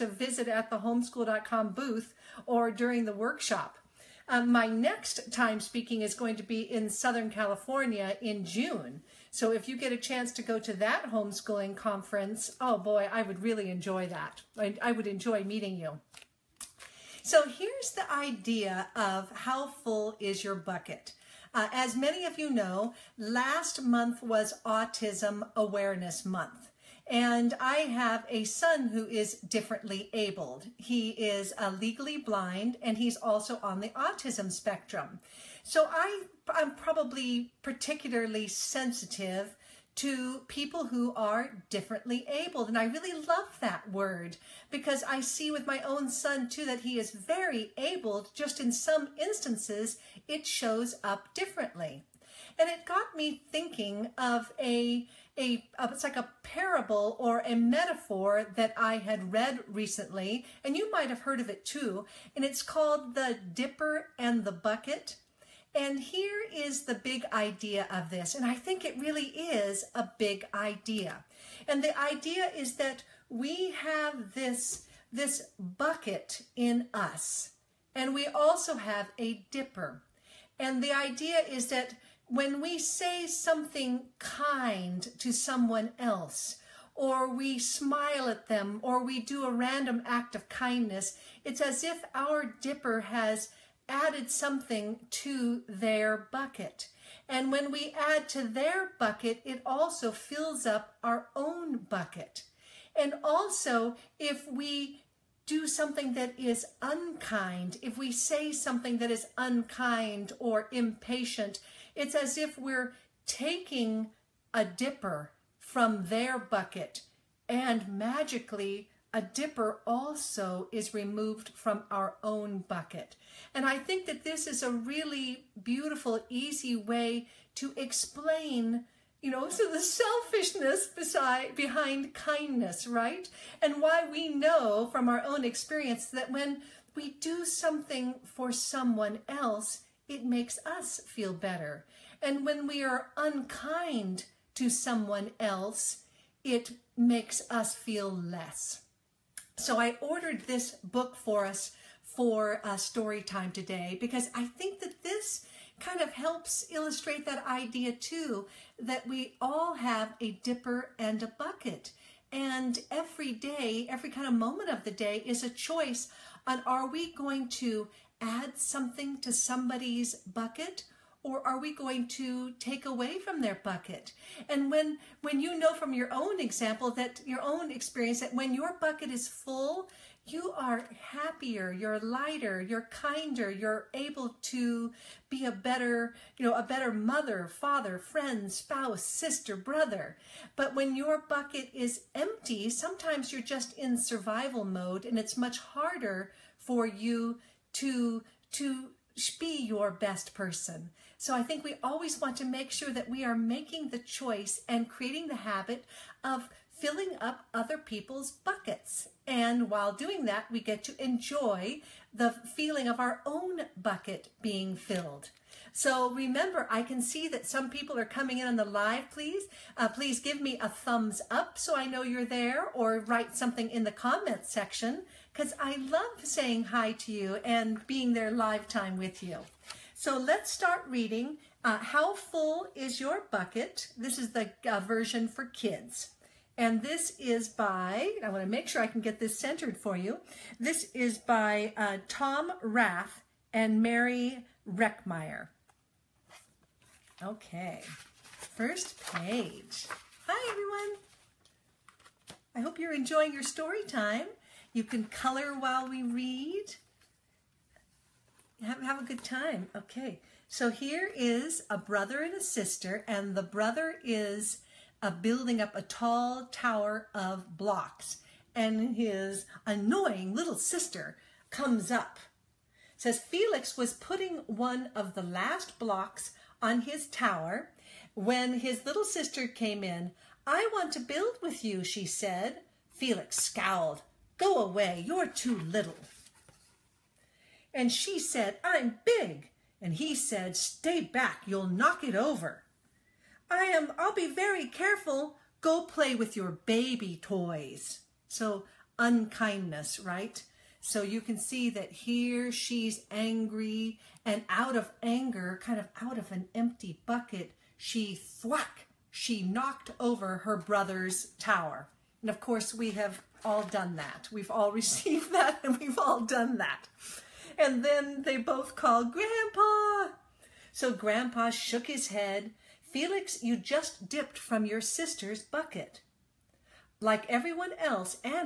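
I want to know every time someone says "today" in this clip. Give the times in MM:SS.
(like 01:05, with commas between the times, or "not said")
02:33.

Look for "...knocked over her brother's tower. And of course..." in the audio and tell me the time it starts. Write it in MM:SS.
05:09.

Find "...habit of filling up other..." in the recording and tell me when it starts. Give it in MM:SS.
03:25.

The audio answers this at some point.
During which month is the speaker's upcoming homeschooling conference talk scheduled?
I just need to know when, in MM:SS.
00:08.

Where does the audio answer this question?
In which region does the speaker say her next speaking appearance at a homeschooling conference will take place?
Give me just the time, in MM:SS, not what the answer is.
00:06.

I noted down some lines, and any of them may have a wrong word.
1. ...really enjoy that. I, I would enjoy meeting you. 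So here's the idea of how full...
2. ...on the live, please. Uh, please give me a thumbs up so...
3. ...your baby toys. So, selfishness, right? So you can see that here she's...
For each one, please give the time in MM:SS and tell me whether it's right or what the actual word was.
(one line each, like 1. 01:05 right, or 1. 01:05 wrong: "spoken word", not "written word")
1. 00:13 right
2. 03:38 right
3. 04:56 wrong: "unkindness", not "selfishness".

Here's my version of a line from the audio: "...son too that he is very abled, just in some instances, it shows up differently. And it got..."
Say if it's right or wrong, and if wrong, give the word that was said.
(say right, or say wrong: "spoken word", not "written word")
right.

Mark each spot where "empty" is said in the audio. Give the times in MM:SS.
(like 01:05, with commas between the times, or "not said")
03:12, 05:06.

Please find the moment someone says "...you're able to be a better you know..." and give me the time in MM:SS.
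03:03.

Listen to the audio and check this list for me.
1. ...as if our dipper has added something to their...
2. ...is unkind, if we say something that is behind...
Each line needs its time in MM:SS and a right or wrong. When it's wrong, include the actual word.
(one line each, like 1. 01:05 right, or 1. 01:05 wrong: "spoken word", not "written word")
1. 01:31 right
2. 01:46 wrong: "unkind", not "behind".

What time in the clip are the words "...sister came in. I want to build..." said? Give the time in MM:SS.
04:39.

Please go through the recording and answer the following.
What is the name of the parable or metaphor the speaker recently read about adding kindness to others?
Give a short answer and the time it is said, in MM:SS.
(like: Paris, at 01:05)
The Dipper and the Bucket, at 01:03.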